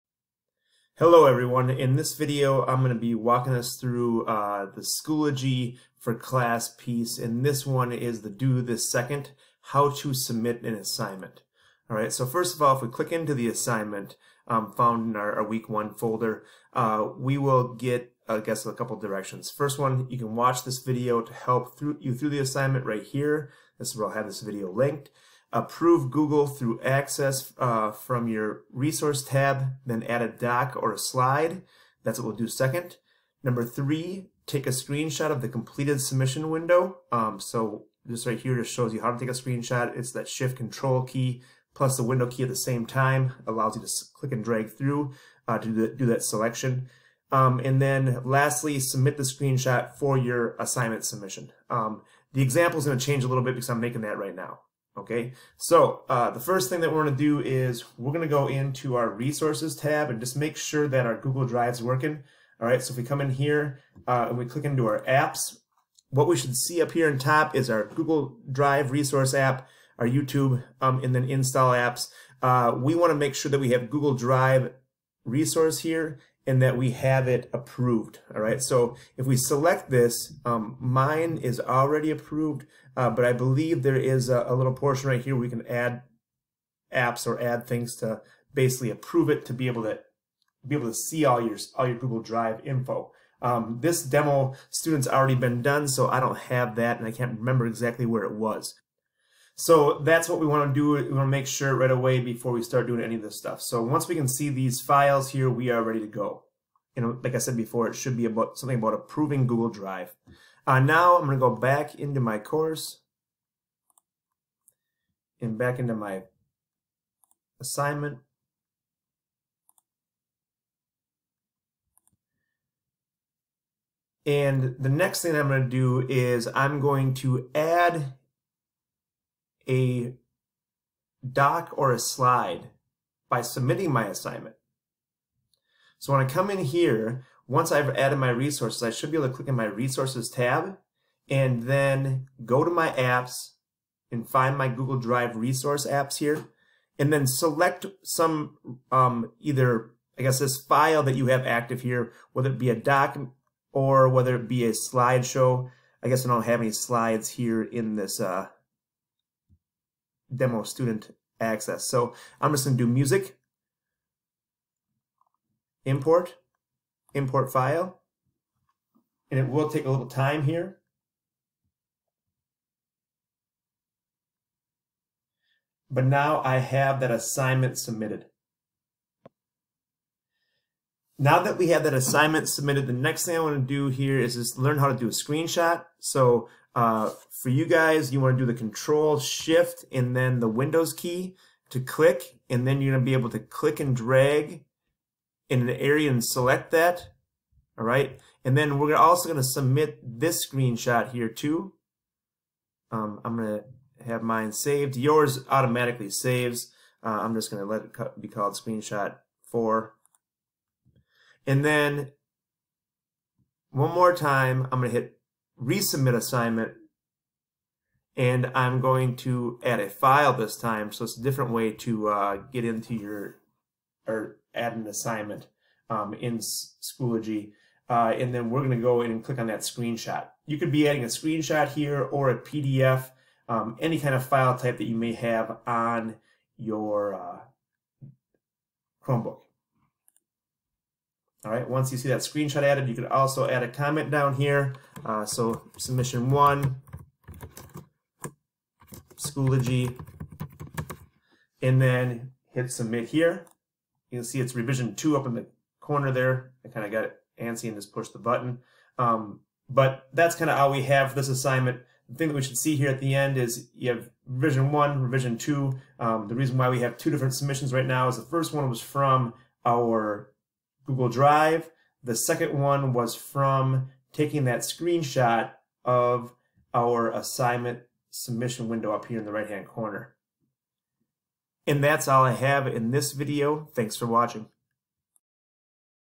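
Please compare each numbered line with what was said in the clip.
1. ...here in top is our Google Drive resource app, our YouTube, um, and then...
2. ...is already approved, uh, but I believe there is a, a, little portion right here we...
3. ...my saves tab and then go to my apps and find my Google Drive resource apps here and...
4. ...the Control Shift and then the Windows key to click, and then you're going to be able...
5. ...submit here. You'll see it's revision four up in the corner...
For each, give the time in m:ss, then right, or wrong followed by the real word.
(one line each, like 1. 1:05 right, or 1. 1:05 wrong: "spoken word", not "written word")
1. 1:06 right
2. 1:21 right
3. 2:19 wrong: "resources", not "saves"
4. 3:08 right
5. 4:12 wrong: "two", not "four".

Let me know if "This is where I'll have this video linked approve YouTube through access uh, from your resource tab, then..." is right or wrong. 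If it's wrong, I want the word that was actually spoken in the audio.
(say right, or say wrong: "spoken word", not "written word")
wrong: "Google", not "YouTube".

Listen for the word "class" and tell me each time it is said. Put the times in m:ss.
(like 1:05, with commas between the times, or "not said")
0:06.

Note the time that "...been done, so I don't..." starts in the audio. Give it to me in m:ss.
1:35.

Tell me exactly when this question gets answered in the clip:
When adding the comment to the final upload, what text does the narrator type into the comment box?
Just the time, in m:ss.
4:05.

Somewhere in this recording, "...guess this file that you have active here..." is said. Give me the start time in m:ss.
2:30.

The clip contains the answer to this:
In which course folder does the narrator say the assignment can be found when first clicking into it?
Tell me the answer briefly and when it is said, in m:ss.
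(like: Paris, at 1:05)
Week one folder, at 0:15.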